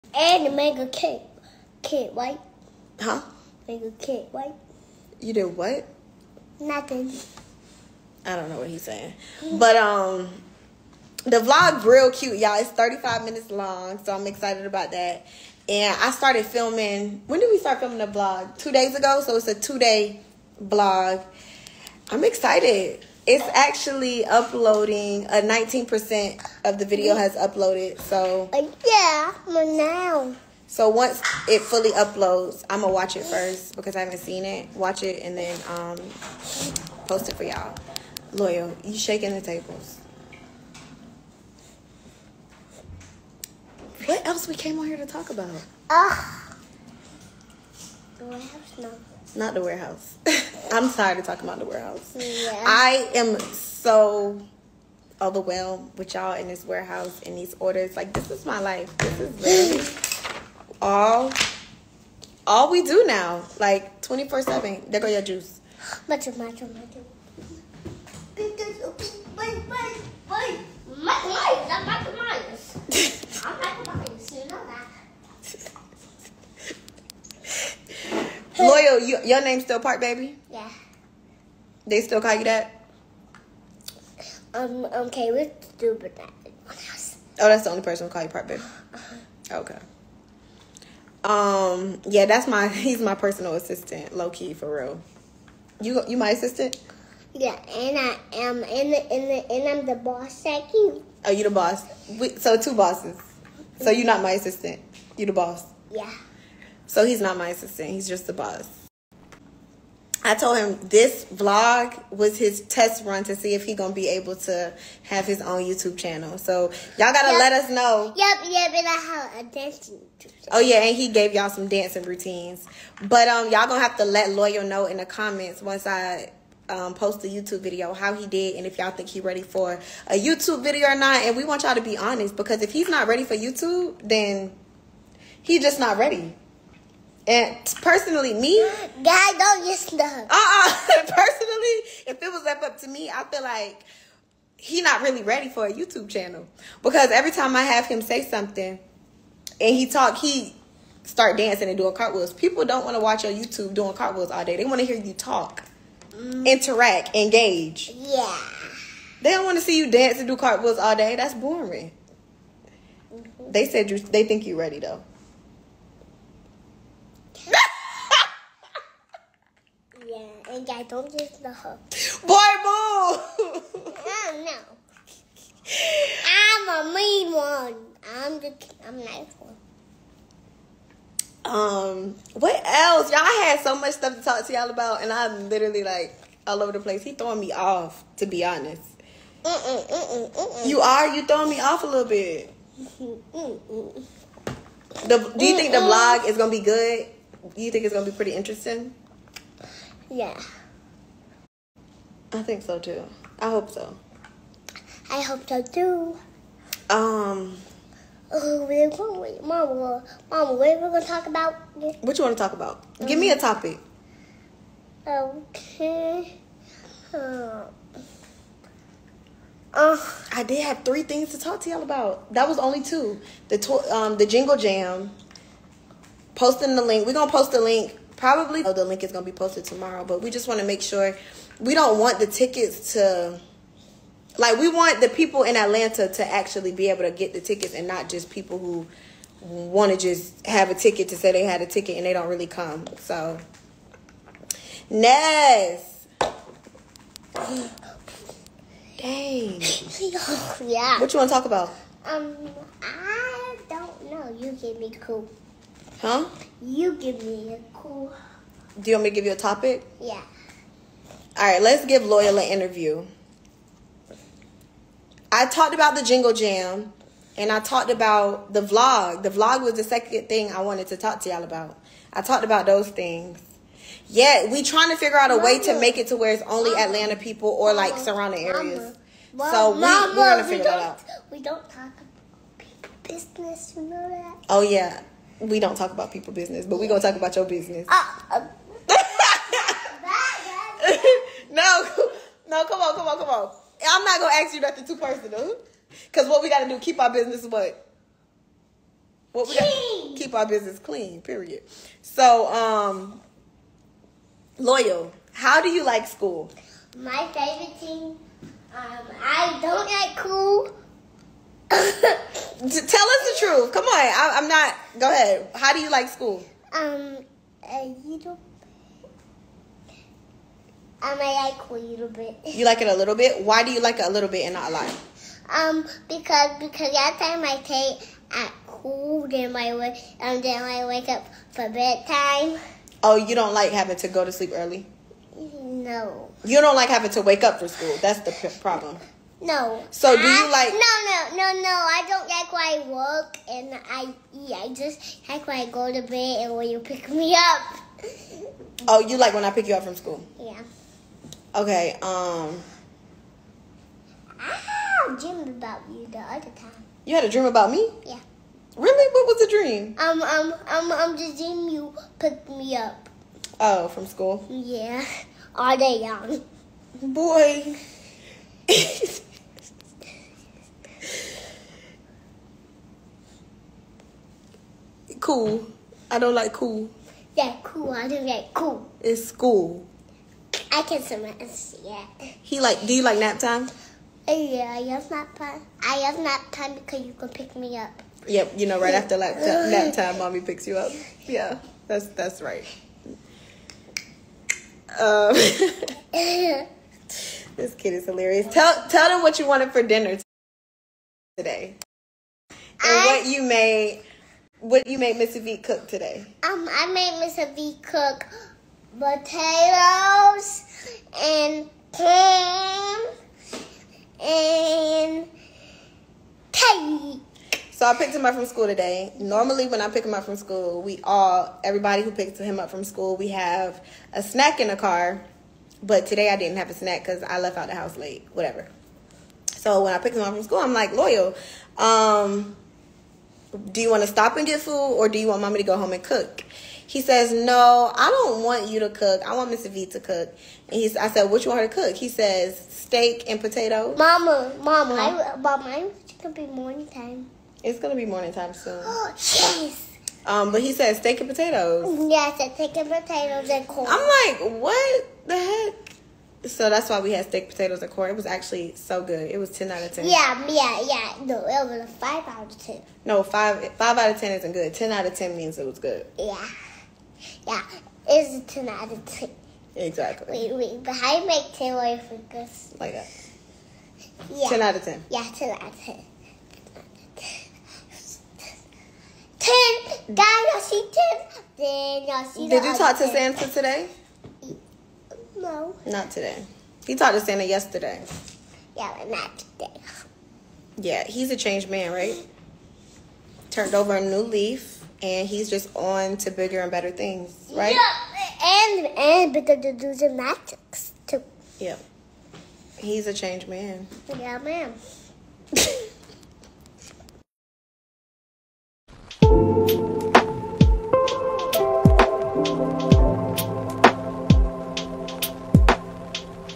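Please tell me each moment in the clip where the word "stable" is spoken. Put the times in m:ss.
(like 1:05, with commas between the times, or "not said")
not said.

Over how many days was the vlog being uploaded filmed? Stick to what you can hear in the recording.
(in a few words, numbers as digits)
2.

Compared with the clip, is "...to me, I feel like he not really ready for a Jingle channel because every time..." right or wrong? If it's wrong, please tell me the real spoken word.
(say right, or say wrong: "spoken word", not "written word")
wrong: "YouTube", not "Jingle".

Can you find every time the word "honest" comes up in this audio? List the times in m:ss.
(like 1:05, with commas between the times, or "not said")
2:11, 3:08.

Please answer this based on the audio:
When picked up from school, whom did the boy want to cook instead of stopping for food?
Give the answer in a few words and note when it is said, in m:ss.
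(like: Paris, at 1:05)
Mr. V, at 7:19.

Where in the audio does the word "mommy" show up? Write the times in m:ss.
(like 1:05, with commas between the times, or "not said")
6:30, 7:15.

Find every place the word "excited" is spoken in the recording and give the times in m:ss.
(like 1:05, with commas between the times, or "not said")
0:14, 0:22.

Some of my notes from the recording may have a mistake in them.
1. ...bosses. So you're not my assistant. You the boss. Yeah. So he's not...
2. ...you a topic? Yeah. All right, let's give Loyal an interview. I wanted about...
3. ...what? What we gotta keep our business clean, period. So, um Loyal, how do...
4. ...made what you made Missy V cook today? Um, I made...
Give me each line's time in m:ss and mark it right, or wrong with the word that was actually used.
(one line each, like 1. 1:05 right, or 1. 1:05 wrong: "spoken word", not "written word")
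1. 1:42 right
2. 4:19 wrong: "talked", not "wanted"
3. 4:57 right
4. 6:43 right.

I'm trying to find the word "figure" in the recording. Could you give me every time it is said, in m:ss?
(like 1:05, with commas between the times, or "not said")
4:34, 4:40.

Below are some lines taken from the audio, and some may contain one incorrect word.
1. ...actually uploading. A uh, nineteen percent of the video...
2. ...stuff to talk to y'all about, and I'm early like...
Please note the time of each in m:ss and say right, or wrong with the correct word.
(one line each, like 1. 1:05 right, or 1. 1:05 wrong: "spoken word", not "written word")
1. 0:23 right
2. 3:03 wrong: "literally", not "early".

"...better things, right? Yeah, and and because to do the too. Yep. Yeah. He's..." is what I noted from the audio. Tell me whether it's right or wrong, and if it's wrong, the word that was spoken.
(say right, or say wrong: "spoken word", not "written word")
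right.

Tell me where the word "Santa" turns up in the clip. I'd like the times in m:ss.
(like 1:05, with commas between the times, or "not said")
8:03, 8:07.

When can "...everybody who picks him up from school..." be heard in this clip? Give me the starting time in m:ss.
7:01.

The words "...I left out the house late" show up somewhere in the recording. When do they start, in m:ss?
7:07.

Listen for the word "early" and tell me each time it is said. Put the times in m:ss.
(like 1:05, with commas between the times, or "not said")
5:34.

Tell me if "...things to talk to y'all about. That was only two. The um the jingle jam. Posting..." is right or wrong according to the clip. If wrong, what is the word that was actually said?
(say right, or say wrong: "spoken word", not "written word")
right.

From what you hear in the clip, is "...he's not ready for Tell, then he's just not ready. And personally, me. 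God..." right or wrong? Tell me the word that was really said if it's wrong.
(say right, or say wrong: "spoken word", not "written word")
wrong: "YouTube", not "Tell".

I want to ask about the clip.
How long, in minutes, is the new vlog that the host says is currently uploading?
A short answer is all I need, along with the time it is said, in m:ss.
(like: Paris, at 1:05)
35 minutes, at 0:12.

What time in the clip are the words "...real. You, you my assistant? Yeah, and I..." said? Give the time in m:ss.
1:34.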